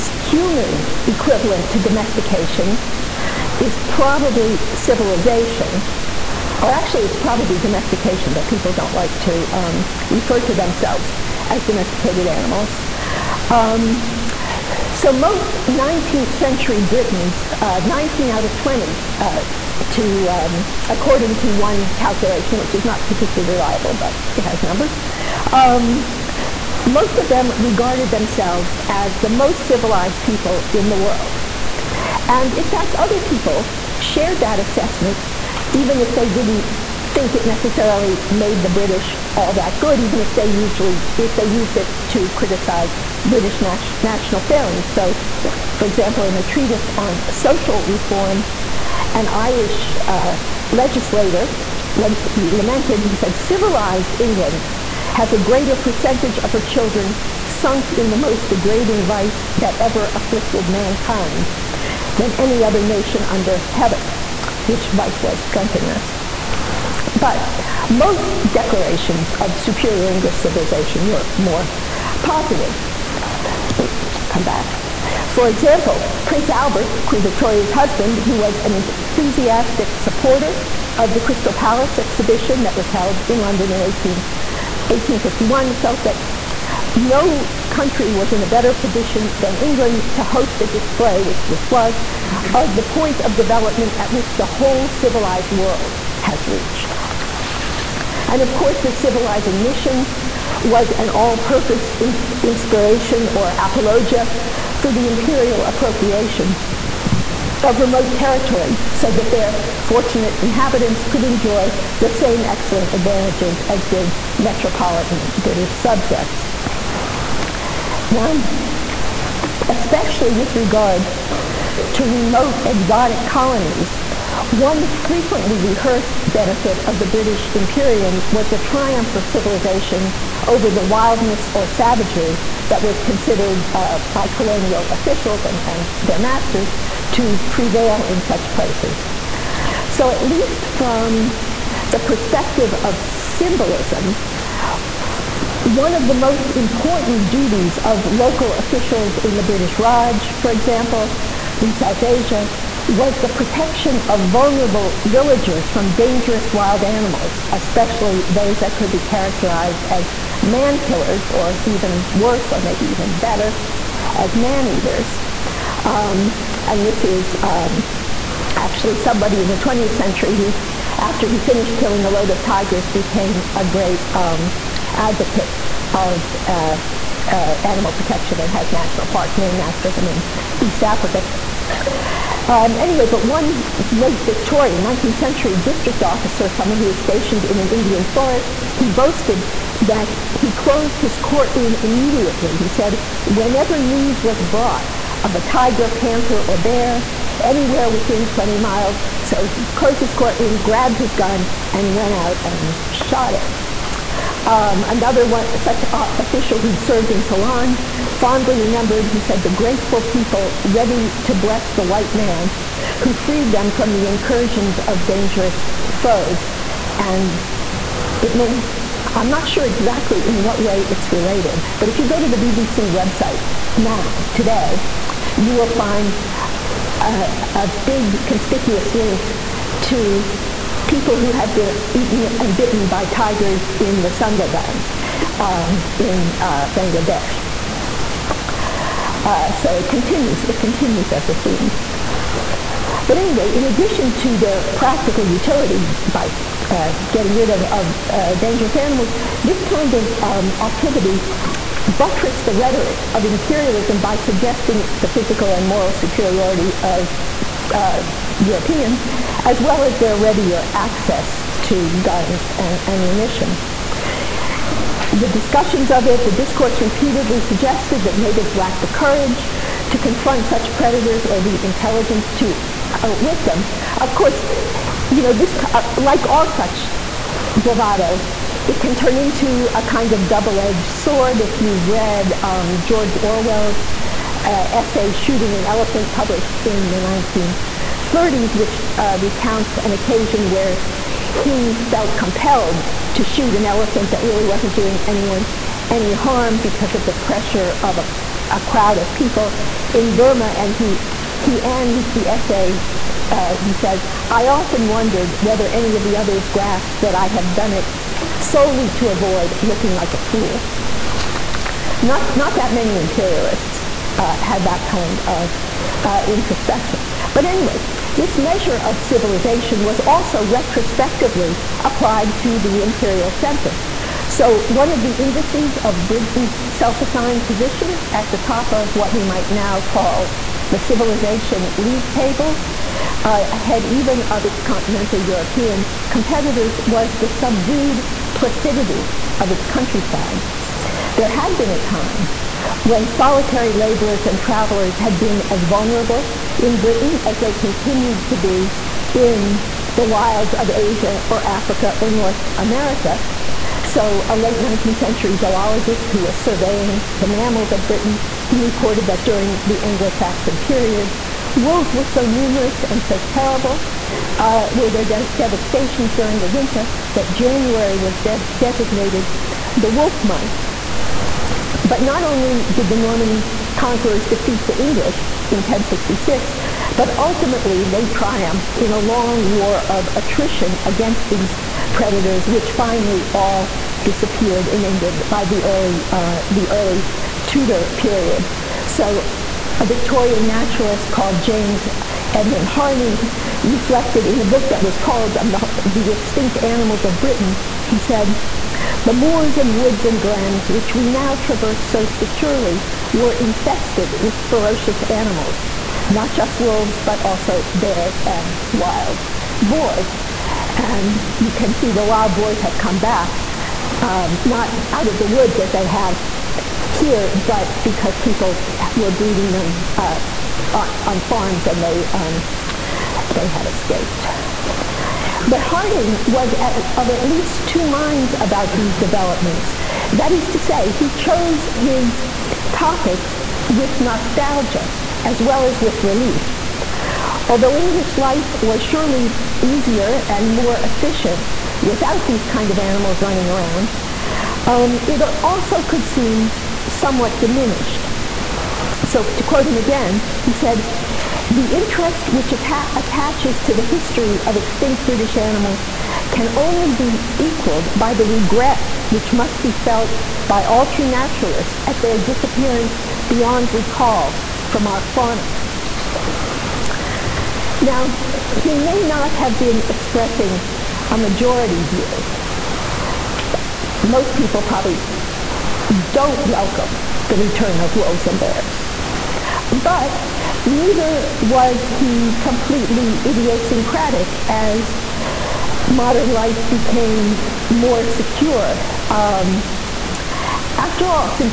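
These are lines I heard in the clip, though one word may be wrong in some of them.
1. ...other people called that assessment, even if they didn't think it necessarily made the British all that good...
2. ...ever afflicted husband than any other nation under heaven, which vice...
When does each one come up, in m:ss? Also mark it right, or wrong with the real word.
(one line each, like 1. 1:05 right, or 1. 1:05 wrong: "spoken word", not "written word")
1. 0:32 wrong: "shared", not "called"
2. 0:59 wrong: "mankind", not "husband".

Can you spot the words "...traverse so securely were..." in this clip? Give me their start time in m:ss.
6:41.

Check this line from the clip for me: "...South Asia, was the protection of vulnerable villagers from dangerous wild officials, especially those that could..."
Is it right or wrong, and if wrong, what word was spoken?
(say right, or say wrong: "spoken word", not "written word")
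wrong: "animals", not "officials".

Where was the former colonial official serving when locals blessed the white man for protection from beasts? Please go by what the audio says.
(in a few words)
Ceylon.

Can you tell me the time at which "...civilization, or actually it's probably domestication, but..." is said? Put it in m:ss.
0:04.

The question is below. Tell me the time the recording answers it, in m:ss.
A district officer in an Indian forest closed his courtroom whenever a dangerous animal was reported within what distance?
3:18.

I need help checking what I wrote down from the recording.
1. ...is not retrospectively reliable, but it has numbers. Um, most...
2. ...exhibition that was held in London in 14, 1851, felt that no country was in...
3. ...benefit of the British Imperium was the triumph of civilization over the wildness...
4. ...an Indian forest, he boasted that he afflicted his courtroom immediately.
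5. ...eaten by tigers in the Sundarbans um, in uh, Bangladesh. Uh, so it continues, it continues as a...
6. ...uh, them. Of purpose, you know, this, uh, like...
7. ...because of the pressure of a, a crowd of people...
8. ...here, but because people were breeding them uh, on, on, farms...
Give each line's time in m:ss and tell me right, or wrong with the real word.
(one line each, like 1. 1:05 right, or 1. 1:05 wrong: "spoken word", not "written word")
1. 0:22 wrong: "particularly", not "retrospectively"
2. 1:21 wrong: "18", not "14"
3. 2:06 right
4. 3:07 wrong: "closed", not "afflicted"
5. 3:52 wrong: "bitten", not "eaten"
6. 4:33 wrong: "course", not "purpose"
7. 4:56 right
8. 6:56 right.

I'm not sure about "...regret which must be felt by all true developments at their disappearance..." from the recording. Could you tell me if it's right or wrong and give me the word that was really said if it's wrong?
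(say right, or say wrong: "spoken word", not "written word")
wrong: "naturalists", not "developments".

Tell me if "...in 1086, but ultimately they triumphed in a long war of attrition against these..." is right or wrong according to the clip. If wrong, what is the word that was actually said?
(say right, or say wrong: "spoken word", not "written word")
wrong: "1066", not "1086".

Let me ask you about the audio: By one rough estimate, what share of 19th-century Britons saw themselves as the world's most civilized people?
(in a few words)
19 out of 20.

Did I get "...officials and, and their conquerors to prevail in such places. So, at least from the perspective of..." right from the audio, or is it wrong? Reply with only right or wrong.
wrong.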